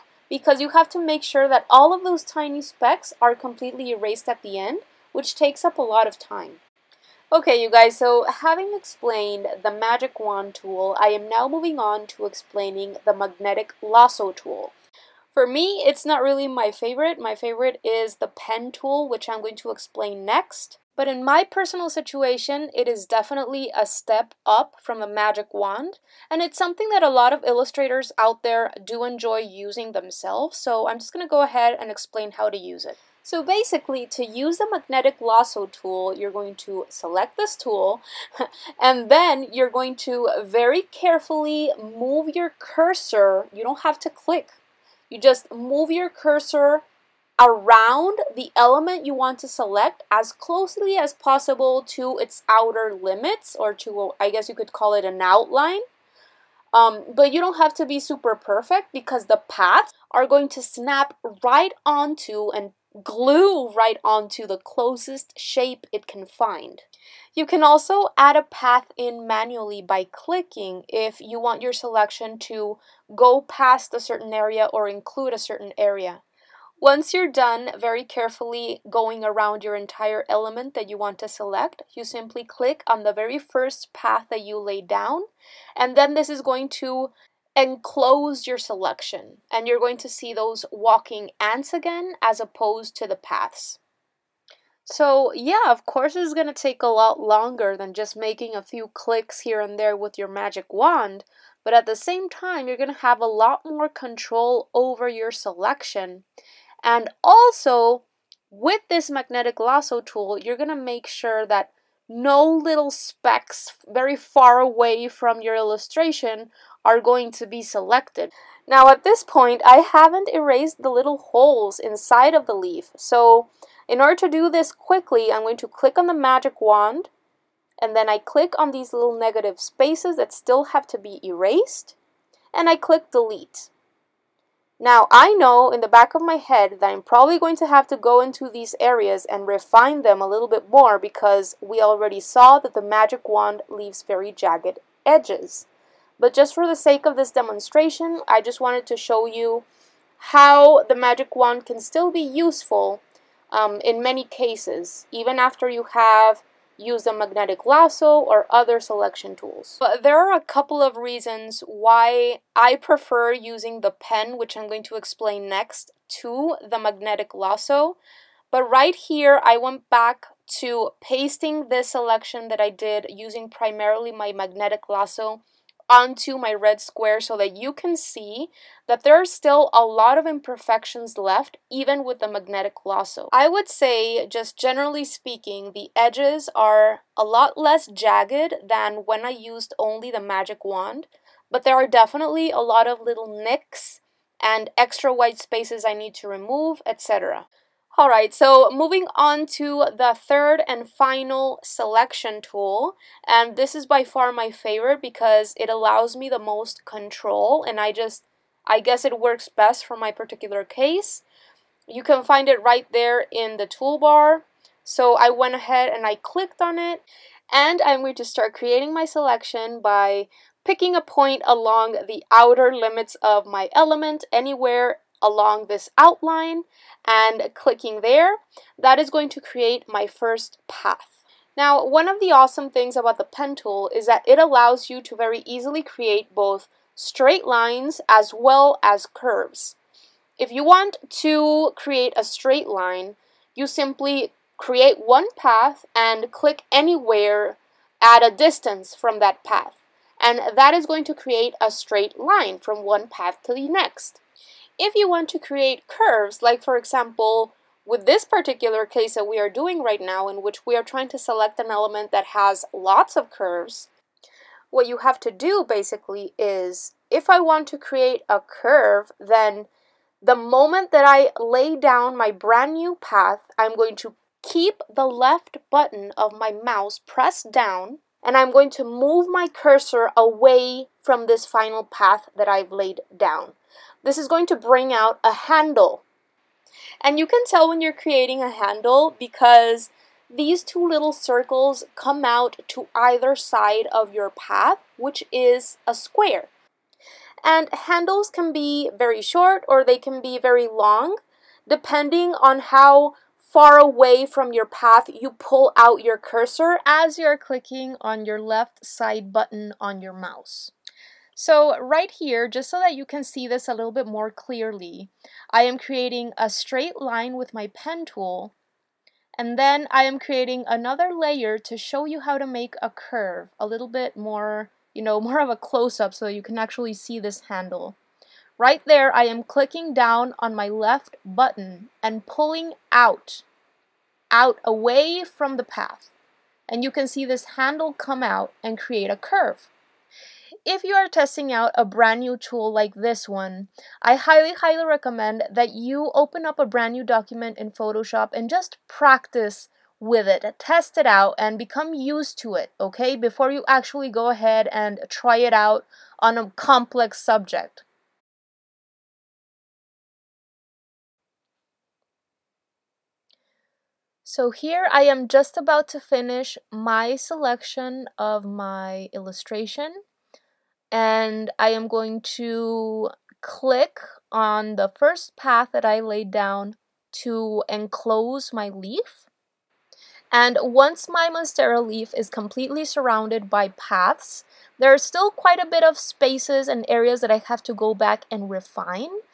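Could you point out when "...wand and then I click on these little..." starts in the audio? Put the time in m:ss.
2:06.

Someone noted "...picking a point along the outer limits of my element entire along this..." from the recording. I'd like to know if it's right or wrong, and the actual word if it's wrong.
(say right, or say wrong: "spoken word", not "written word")
wrong: "anywhere", not "entire".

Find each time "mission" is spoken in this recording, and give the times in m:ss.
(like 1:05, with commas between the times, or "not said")
not said.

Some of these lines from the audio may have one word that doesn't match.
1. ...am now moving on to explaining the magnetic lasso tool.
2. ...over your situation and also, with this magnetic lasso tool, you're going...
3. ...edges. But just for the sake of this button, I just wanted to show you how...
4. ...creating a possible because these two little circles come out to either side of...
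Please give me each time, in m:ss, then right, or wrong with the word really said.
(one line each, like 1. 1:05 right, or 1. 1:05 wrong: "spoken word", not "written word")
1. 0:11 right
2. 1:44 wrong: "selection", not "situation"
3. 2:25 wrong: "demonstration", not "button"
4. 4:47 wrong: "handle", not "possible".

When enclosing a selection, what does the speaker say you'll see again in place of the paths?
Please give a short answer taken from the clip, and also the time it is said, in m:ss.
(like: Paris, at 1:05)
Walking ants, at 1:30.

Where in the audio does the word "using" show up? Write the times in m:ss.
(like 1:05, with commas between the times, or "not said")
0:29, 2:43, 2:53.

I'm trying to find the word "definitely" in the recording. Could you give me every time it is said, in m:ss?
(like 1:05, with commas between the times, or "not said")
0:23, 3:11.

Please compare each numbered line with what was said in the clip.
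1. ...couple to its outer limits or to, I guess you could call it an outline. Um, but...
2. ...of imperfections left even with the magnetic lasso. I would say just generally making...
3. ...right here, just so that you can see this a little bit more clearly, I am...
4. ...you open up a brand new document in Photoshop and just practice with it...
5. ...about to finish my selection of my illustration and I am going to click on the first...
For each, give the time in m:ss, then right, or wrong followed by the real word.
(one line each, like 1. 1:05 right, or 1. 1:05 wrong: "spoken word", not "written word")
1. 0:51 wrong: "possible", not "couple"
2. 3:00 wrong: "speaking", not "making"
3. 5:11 right
4. 5:45 right
5. 6:05 right.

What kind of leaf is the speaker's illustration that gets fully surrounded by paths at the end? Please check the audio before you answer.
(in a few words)
Monstera leaf.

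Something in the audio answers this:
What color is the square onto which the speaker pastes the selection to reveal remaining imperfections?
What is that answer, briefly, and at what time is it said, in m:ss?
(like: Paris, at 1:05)
Red, at 2:56.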